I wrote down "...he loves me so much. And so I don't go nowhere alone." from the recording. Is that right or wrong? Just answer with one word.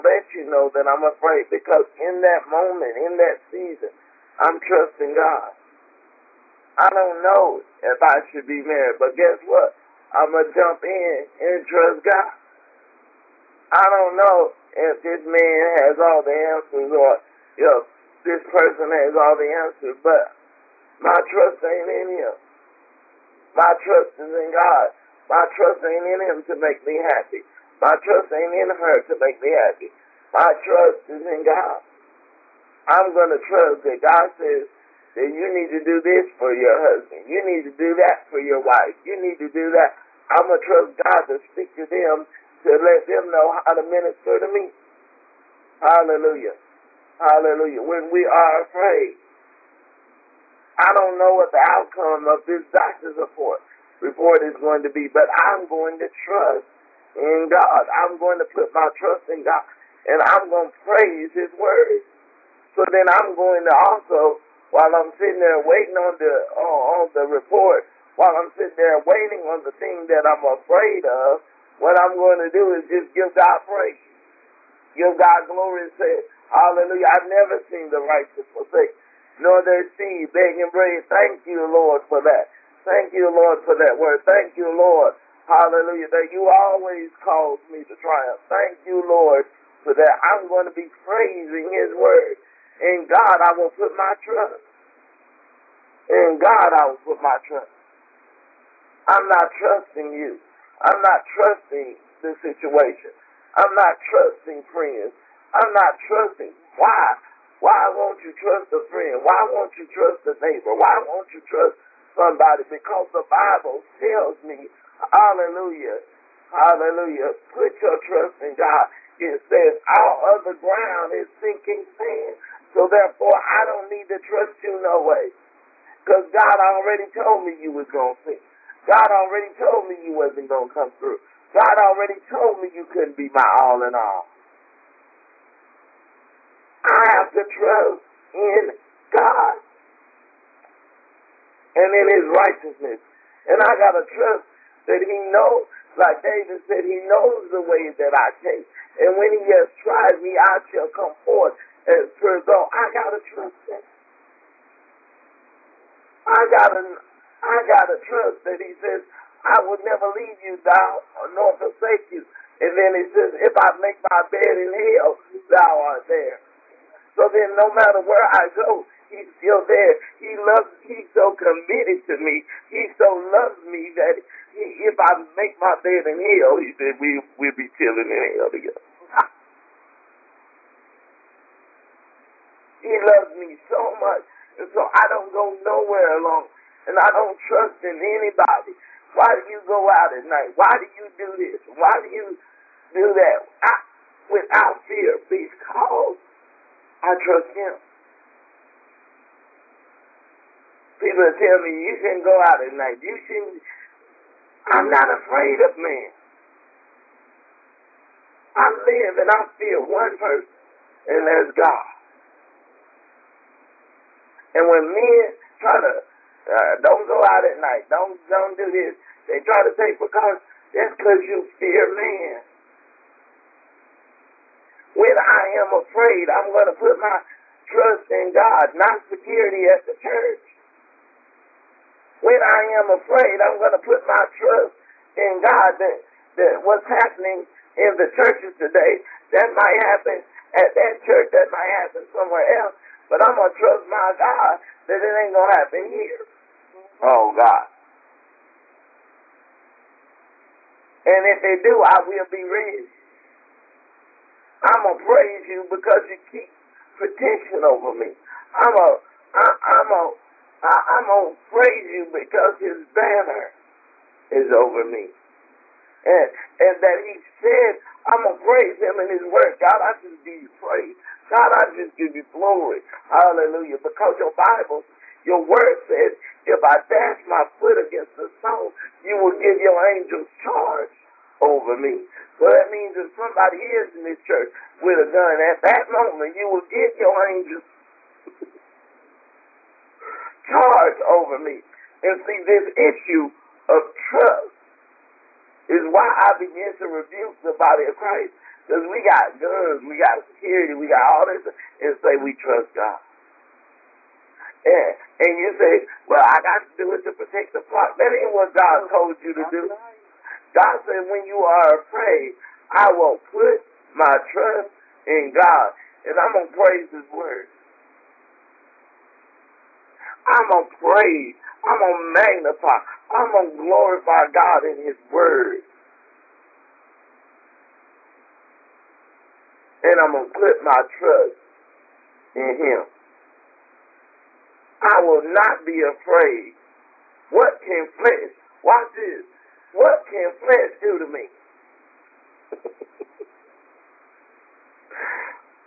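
right.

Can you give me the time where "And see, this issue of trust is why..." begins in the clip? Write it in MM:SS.
04:52.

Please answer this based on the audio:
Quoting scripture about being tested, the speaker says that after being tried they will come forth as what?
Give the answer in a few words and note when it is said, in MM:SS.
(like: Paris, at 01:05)
pure gold, at 02:32.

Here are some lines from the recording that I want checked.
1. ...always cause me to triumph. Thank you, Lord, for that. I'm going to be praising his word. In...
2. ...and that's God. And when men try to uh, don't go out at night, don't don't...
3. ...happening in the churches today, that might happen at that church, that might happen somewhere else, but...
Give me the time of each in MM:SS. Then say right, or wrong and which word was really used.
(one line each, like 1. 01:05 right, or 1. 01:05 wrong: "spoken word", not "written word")
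1. 01:26 right
2. 03:31 right
3. 03:56 right.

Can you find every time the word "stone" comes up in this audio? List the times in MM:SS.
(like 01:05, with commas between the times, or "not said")
04:38.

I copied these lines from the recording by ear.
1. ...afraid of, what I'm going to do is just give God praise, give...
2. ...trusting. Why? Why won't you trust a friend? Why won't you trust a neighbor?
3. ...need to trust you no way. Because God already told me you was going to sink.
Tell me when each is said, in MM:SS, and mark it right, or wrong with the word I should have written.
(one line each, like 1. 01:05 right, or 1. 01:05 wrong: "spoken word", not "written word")
1. 01:10 right
2. 01:46 right
3. 02:03 right.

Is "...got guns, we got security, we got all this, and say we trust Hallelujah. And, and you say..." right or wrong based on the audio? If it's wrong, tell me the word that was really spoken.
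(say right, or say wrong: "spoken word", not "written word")
wrong: "God", not "Hallelujah".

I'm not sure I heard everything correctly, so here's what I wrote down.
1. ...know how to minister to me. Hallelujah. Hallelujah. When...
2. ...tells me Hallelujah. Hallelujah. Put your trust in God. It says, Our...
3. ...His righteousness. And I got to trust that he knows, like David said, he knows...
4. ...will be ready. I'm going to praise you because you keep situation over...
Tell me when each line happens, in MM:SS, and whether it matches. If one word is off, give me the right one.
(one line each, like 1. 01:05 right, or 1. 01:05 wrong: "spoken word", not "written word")
1. 00:43 right
2. 01:53 right
3. 02:22 right
4. 04:12 wrong: "protection", not "situation".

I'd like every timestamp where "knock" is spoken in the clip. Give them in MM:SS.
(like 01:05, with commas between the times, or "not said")
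not said.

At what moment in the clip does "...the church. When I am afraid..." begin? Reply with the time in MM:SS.
03:49.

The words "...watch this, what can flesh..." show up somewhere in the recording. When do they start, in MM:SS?
05:38.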